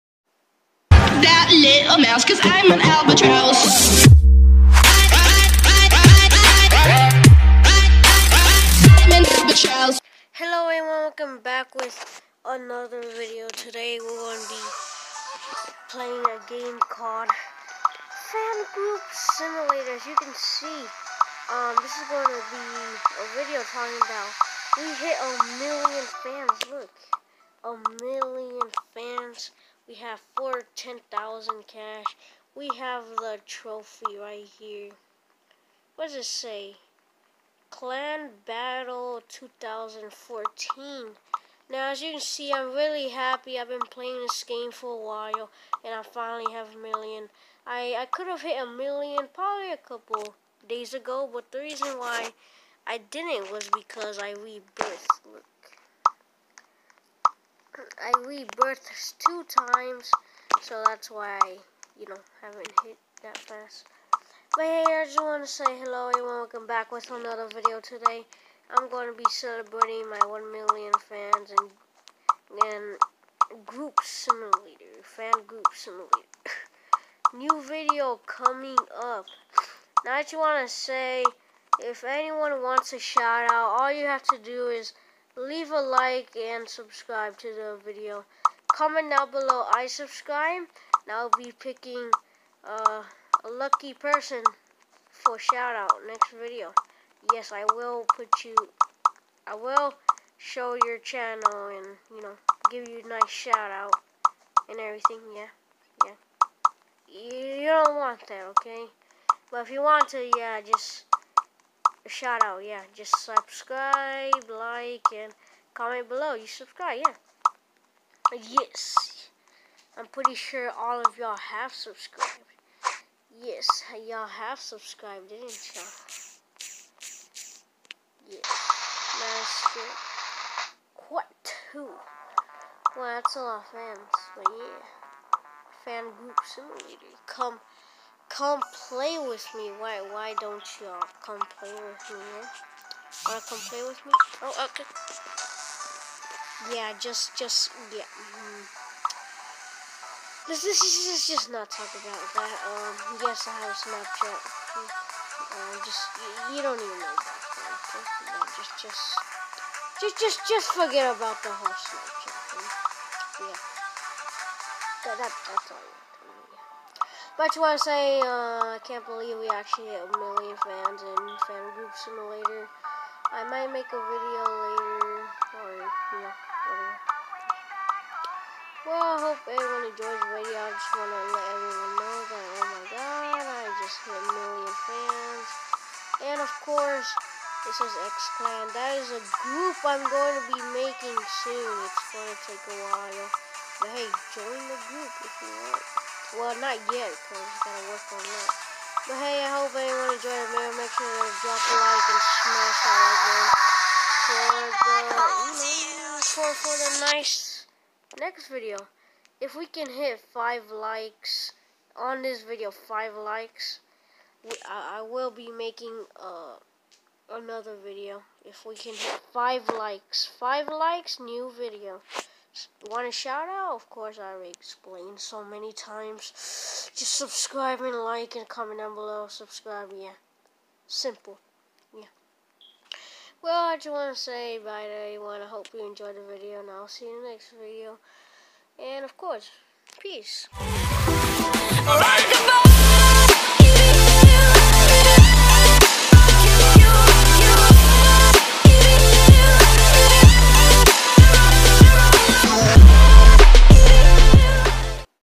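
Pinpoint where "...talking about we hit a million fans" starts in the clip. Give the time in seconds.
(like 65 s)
23 s.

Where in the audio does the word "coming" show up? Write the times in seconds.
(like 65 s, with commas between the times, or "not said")
78 s.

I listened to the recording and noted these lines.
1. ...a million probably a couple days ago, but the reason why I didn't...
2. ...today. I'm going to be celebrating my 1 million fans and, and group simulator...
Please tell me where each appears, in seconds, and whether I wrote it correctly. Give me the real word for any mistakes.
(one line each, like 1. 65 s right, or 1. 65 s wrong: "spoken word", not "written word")
1. 48 s right
2. 67 s right.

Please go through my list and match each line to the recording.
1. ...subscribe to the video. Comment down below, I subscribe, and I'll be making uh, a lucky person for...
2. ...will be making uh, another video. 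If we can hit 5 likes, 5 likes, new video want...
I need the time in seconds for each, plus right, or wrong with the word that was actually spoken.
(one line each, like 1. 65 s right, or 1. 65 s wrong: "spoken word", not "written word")
1. 86 s wrong: "picking", not "making"
2. 215 s right.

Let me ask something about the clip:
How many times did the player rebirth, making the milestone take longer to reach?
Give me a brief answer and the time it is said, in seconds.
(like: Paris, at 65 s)
2, at 59 s.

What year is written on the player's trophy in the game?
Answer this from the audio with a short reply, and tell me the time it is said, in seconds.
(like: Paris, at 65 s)
2014, at 39 s.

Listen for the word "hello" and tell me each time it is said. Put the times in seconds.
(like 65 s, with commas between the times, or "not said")
10 s, 65 s.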